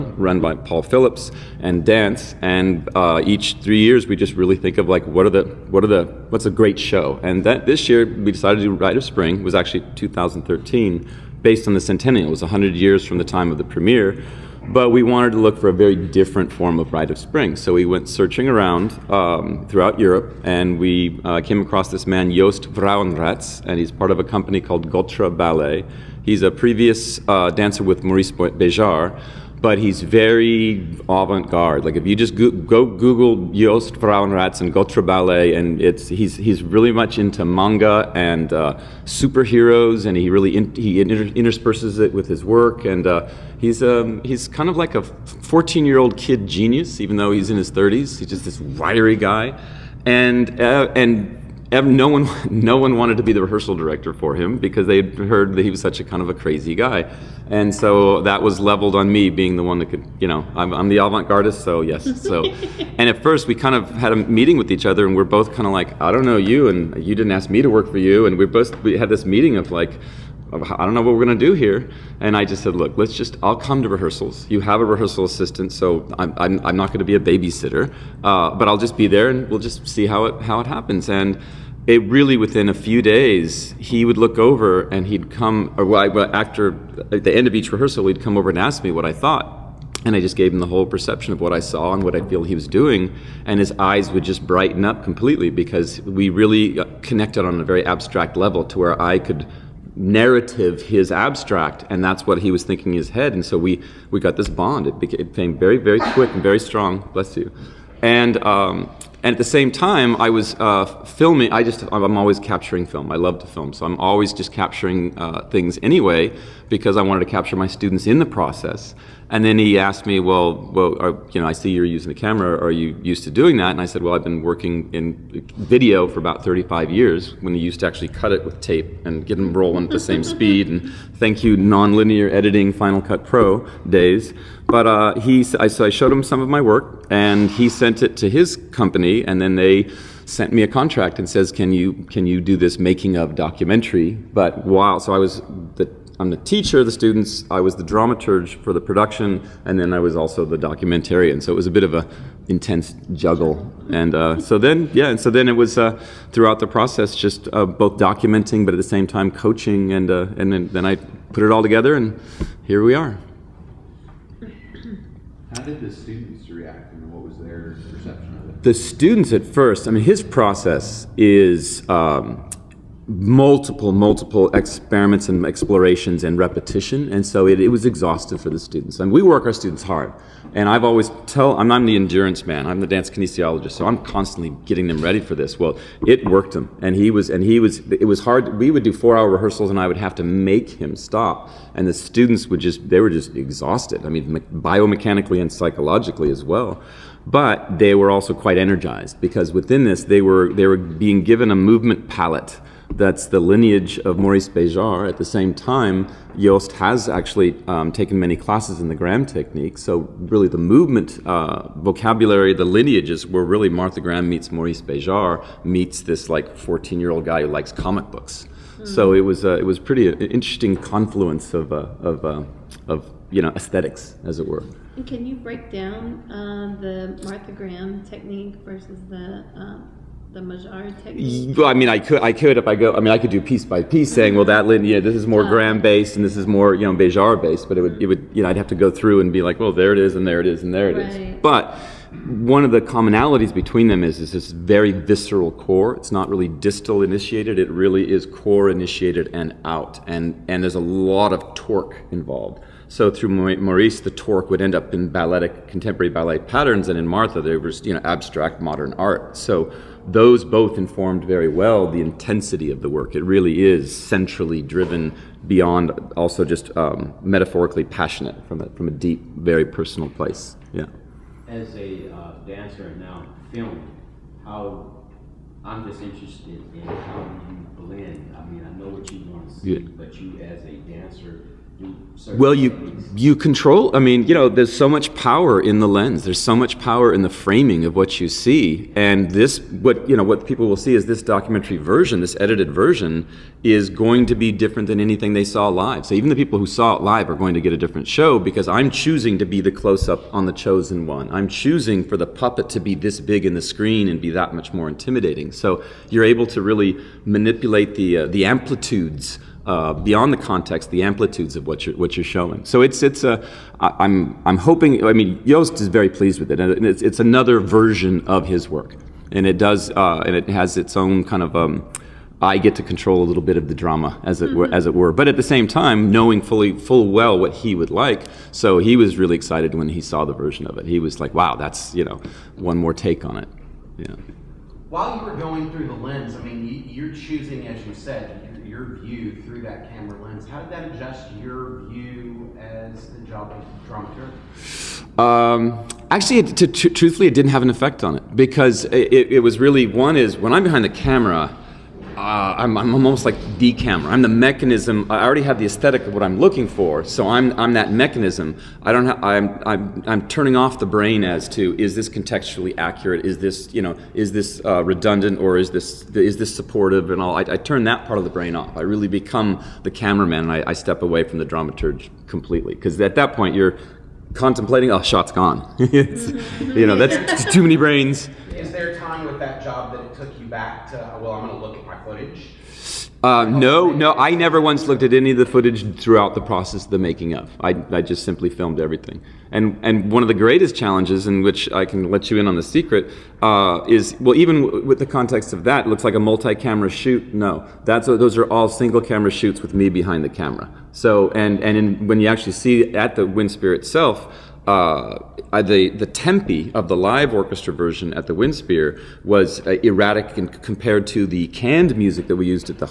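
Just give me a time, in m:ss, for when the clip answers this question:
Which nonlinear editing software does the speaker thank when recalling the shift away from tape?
2:12.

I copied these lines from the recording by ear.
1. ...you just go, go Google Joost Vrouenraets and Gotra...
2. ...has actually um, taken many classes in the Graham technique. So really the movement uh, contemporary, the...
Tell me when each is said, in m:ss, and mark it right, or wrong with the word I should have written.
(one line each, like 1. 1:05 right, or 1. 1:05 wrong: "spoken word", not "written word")
1. 0:32 right
2. 3:26 wrong: "vocabulary", not "contemporary".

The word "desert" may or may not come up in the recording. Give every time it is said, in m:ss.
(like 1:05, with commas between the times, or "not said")
not said.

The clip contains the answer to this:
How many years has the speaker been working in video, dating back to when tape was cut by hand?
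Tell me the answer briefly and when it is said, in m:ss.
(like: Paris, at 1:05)
35, at 2:06.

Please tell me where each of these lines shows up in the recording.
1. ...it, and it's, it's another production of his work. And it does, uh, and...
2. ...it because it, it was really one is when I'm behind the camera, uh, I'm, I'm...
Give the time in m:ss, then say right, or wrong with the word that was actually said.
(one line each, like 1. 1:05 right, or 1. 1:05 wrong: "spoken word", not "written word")
1. 5:16 wrong: "version", not "production"
2. 5:48 right.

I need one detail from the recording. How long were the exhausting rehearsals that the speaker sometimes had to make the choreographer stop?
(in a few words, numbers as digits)
4 hours.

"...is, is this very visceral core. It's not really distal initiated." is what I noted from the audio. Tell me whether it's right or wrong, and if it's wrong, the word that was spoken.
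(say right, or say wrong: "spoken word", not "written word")
right.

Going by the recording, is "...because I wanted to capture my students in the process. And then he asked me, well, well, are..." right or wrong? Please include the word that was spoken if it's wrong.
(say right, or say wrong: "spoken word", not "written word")
right.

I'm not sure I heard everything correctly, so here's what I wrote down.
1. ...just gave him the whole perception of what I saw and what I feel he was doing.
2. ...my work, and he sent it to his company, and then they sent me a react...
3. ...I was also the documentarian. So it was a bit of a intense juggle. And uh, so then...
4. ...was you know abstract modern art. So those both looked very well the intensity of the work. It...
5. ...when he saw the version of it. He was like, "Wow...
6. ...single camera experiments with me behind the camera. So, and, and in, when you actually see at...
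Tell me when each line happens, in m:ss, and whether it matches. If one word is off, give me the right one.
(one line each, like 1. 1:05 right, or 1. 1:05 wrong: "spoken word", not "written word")
1. 1:30 right
2. 2:16 wrong: "contract", not "react"
3. 2:29 right
4. 4:17 wrong: "informed", not "looked"
5. 5:29 right
6. 6:38 wrong: "shoots", not "experiments".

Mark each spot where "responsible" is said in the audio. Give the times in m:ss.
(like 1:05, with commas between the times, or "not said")
not said.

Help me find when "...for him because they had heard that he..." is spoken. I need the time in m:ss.
0:54.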